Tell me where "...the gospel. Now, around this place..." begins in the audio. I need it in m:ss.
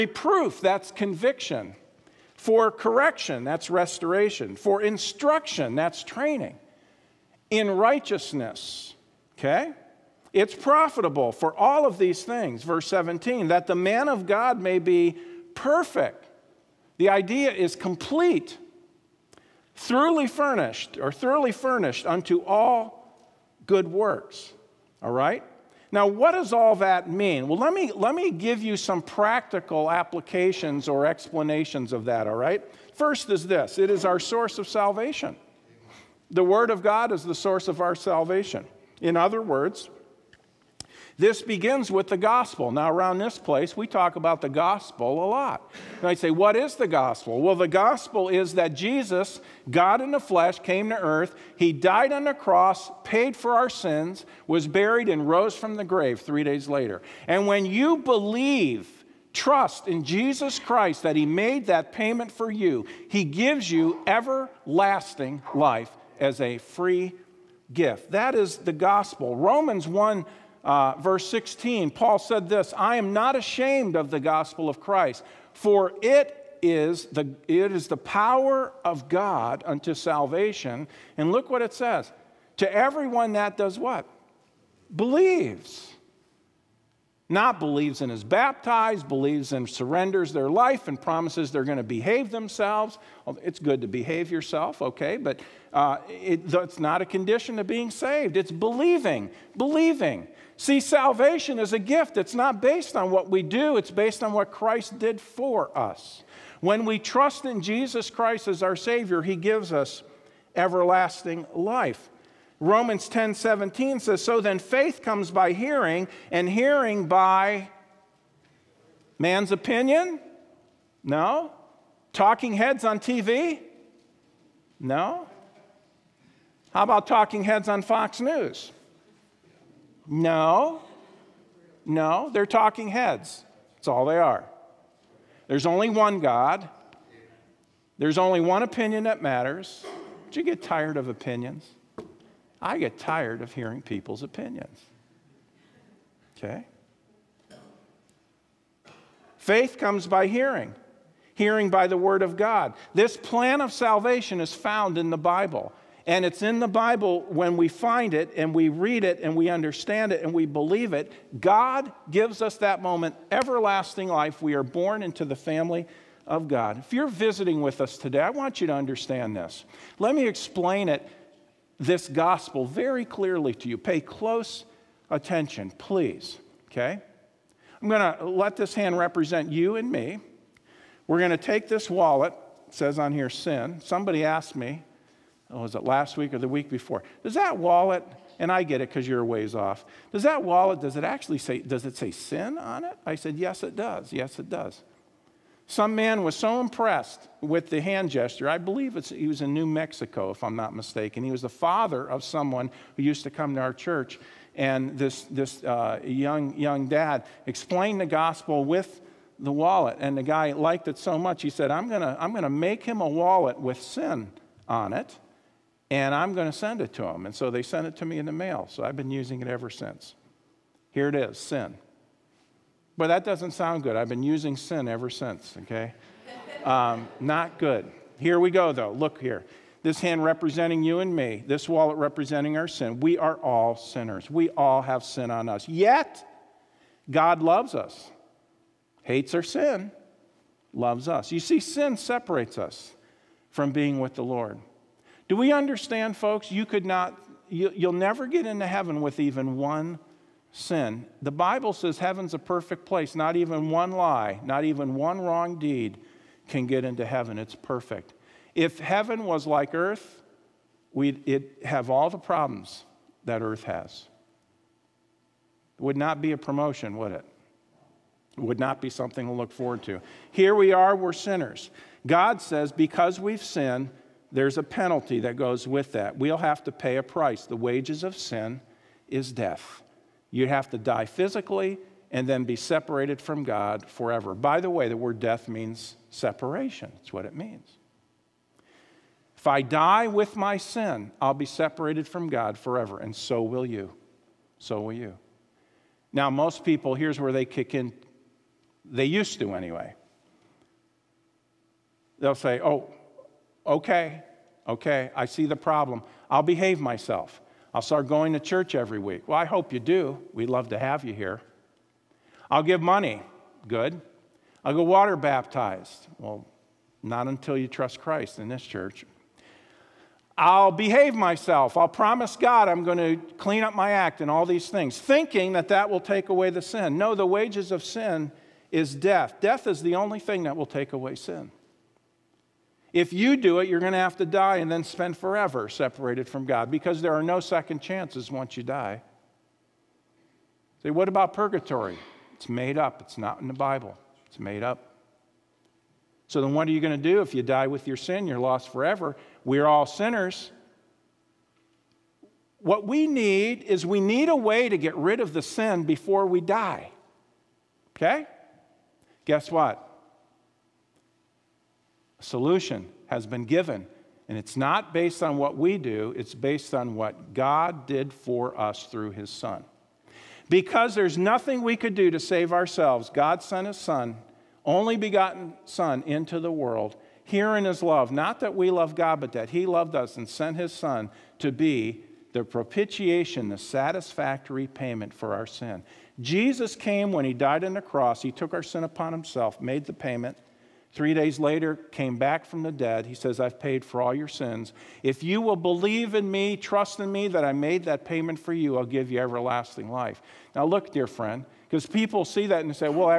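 0:42.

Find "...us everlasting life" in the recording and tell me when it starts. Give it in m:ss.
1:49.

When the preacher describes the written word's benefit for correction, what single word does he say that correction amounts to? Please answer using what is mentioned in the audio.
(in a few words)
Restoration.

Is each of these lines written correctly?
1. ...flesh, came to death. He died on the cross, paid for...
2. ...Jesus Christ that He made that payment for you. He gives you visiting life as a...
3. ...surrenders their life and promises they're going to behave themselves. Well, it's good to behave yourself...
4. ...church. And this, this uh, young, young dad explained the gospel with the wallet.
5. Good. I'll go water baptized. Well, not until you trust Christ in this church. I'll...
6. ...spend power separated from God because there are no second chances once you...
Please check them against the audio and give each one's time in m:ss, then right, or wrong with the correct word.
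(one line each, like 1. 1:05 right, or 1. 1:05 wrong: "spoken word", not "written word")
1. 0:50 wrong: "earth", not "death"
2. 1:00 wrong: "everlasting", not "visiting"
3. 1:29 right
4. 3:23 right
5. 5:13 right
6. 5:34 wrong: "forever", not "power".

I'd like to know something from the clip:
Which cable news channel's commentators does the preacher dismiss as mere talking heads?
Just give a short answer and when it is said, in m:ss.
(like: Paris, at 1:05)
Fox News, at 2:07.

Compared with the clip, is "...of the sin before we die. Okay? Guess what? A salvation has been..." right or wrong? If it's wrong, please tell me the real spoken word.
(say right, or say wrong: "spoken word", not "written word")
wrong: "solution", not "salvation".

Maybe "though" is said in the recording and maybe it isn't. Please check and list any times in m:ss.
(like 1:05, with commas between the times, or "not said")
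3:48.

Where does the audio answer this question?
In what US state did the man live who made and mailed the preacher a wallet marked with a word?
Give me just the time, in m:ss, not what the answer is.
3:19.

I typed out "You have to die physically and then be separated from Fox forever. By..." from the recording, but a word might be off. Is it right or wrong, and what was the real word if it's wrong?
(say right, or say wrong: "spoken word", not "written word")
wrong: "God", not "Fox".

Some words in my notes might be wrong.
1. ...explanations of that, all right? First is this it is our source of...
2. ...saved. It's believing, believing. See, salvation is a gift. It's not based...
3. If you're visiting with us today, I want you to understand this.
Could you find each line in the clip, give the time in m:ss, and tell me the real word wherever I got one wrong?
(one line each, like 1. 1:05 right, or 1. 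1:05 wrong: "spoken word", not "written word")
1. 0:31 right
2. 1:37 right
3. 2:46 right.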